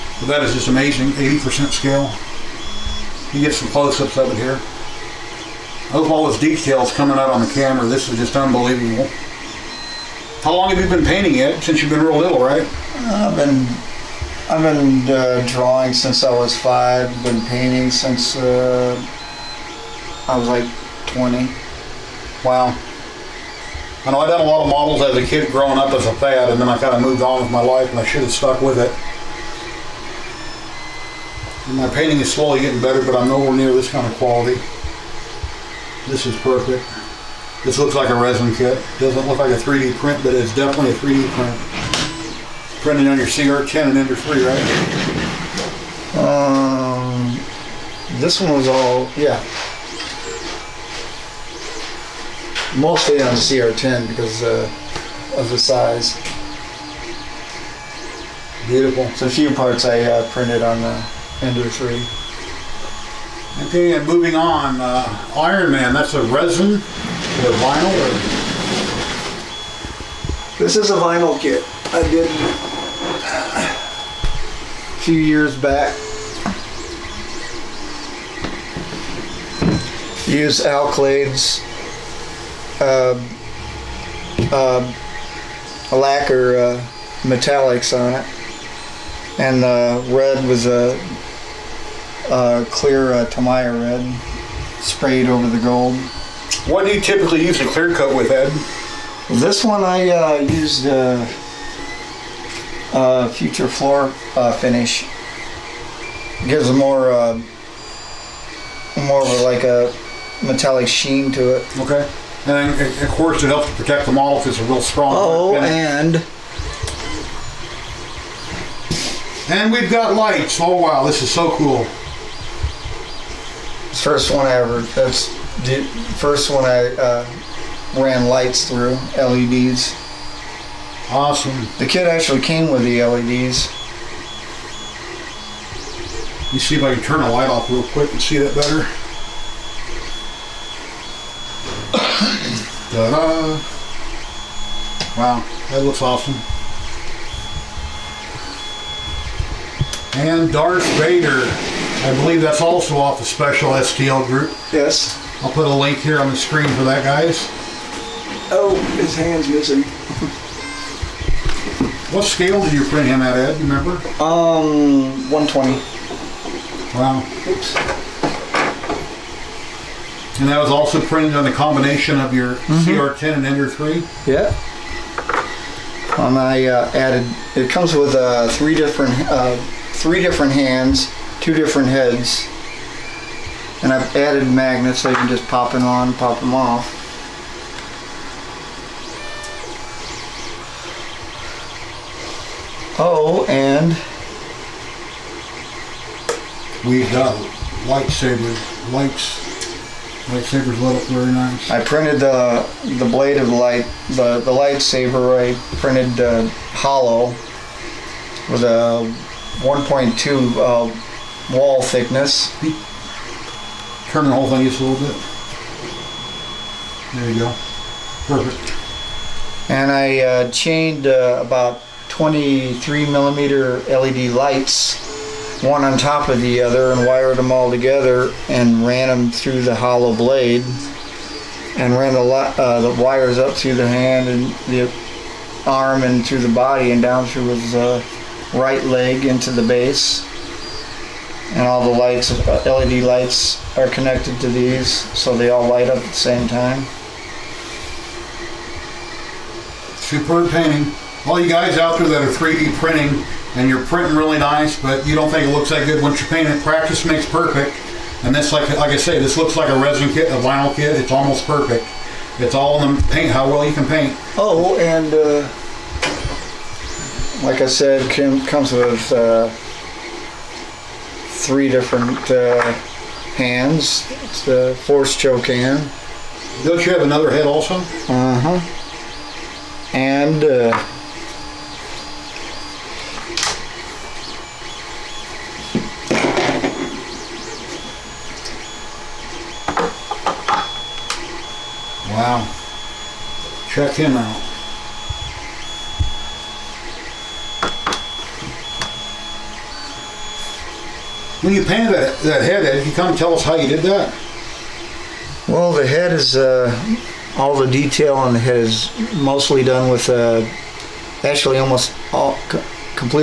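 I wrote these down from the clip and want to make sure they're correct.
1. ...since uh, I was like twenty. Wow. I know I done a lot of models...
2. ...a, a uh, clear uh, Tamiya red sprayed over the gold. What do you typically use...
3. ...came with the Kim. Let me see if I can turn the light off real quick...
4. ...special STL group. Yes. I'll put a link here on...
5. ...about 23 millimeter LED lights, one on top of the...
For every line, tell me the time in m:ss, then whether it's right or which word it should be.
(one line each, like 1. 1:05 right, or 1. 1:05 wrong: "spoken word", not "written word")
1. 0:17 right
2. 1:30 right
3. 2:12 wrong: "LEDs", not "Kim"
4. 2:33 right
5. 3:41 right.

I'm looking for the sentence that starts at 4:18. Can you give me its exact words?
And this, like, like I say, this looks like a resin kit, a vinyl kit.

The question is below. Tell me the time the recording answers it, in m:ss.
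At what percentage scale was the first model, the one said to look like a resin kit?
0:01.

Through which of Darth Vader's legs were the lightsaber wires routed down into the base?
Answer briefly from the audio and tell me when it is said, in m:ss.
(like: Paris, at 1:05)
Right leg, at 3:58.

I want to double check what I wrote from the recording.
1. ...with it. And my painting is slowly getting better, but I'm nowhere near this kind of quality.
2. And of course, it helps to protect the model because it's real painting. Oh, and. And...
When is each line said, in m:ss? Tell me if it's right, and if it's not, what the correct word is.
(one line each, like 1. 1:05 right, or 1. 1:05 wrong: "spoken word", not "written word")
1. 0:28 right
2. 1:52 wrong: "strong", not "painting".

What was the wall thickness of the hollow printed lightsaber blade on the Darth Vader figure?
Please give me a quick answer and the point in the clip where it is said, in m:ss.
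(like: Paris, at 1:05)
1.2, at 3:29.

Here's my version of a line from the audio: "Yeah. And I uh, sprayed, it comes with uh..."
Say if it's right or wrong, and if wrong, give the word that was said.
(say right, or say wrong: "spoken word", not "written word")
wrong: "added", not "sprayed".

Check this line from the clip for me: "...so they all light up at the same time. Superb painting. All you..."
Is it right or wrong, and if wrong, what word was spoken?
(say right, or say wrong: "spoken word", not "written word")
right.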